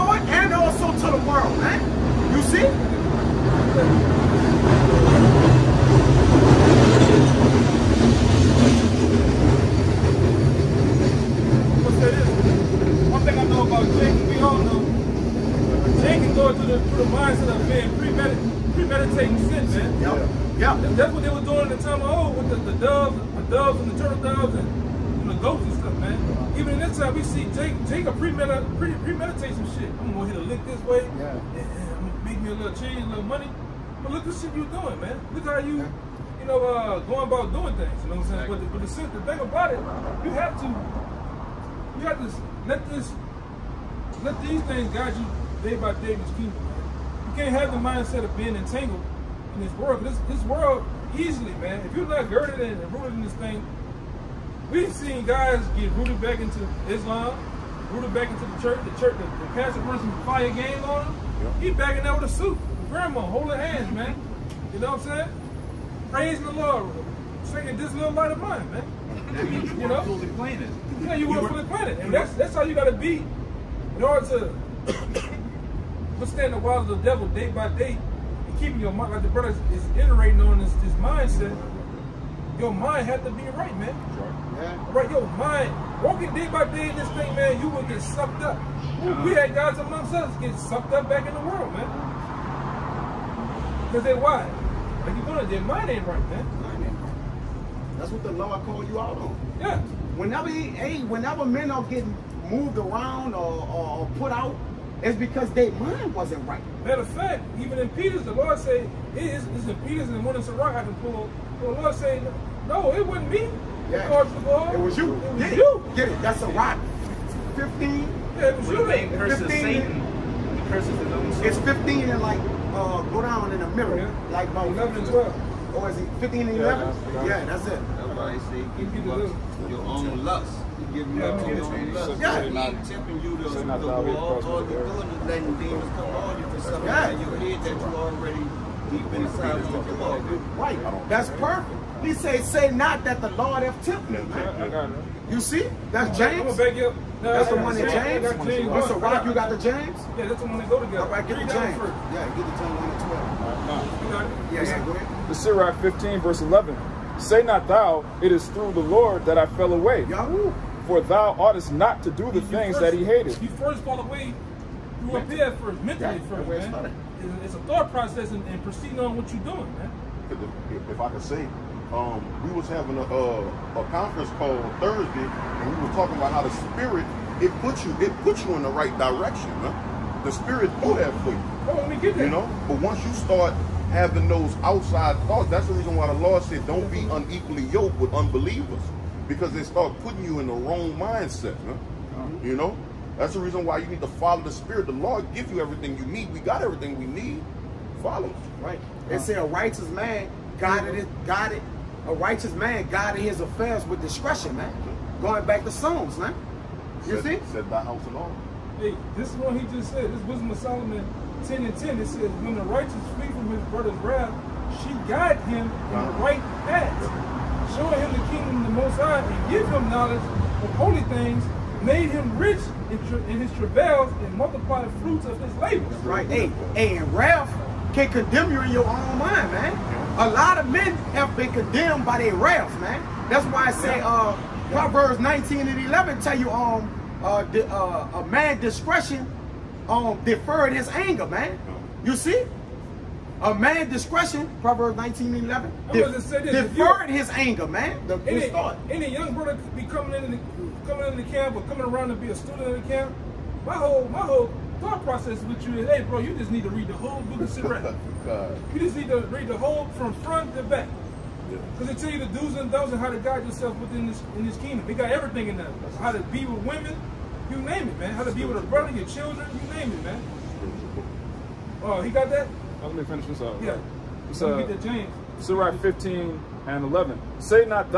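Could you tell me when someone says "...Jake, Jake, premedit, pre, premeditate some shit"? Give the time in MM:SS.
00:27.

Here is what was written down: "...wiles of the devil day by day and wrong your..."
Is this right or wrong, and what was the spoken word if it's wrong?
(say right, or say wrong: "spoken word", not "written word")
wrong: "keeping", not "wrong".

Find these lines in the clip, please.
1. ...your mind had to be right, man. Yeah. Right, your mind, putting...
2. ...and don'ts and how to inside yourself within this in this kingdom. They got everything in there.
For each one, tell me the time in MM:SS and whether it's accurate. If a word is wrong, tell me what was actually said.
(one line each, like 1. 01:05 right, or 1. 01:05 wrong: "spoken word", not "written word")
1. 01:22 wrong: "walking", not "putting"
2. 04:22 wrong: "guide", not "inside".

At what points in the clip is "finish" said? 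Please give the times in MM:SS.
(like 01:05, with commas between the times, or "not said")
04:33.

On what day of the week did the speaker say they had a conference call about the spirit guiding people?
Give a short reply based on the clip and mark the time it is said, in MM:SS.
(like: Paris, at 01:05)
Thursday, at 02:54.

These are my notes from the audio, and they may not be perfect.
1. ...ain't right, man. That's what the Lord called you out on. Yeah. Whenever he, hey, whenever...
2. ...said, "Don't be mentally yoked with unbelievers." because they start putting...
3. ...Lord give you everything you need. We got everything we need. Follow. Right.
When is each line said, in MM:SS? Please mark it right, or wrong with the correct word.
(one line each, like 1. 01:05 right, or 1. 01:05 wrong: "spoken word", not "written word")
1. 01:35 right
2. 03:06 wrong: "unequally", not "mentally"
3. 03:14 right.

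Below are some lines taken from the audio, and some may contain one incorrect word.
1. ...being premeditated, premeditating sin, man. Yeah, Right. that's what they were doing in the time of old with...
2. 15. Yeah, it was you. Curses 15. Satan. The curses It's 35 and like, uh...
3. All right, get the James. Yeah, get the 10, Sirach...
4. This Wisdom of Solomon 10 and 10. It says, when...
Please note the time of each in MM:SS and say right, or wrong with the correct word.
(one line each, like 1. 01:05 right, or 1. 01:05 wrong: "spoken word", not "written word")
1. 00:17 wrong: "Yeah", not "Right"
2. 01:57 wrong: "15", not "35"
3. 02:31 wrong: "The", not "Sirach"
4. 03:30 right.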